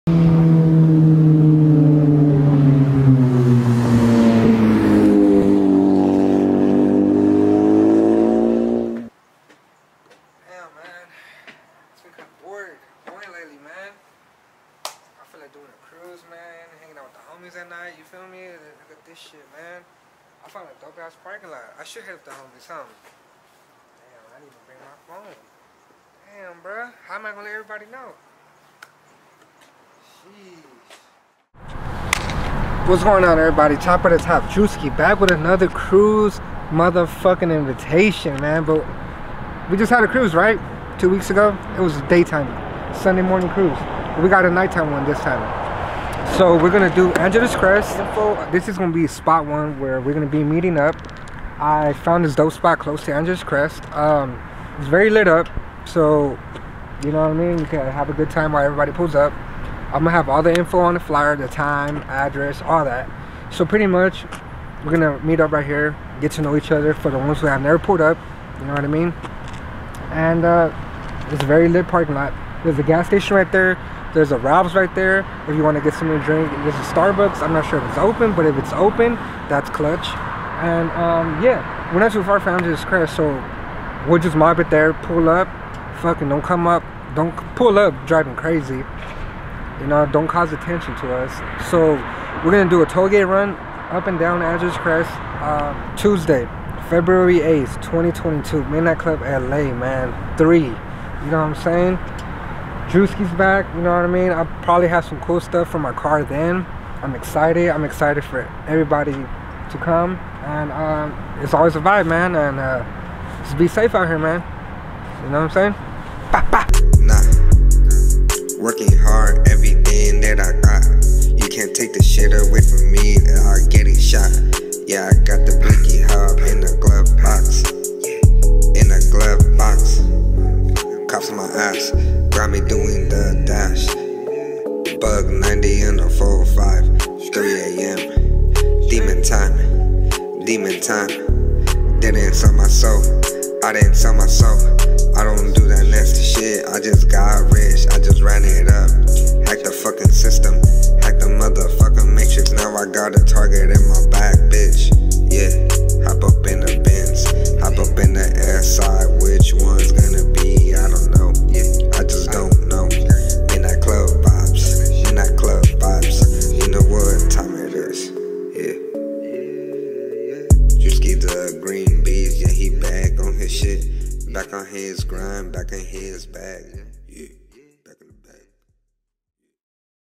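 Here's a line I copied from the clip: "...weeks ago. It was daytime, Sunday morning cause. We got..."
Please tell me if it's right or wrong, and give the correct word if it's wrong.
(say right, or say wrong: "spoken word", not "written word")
wrong: "cruise", not "cause".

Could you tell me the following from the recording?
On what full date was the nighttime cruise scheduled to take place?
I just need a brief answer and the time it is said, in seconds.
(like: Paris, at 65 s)
Tuesday, February 8th, 2022, at 95 s.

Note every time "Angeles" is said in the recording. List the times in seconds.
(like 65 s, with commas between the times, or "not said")
47 s, 53 s, 82 s, 94 s.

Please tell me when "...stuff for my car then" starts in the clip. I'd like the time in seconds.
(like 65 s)
105 s.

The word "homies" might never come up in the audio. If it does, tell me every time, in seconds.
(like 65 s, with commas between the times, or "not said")
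17 s, 22 s.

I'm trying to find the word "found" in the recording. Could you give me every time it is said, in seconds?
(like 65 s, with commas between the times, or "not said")
20 s, 51 s.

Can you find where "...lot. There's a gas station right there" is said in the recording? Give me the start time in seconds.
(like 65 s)
72 s.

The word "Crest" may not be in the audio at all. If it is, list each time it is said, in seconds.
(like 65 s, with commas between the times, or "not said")
47 s, 53 s, 82 s, 94 s.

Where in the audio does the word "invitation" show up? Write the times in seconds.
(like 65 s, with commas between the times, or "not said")
37 s.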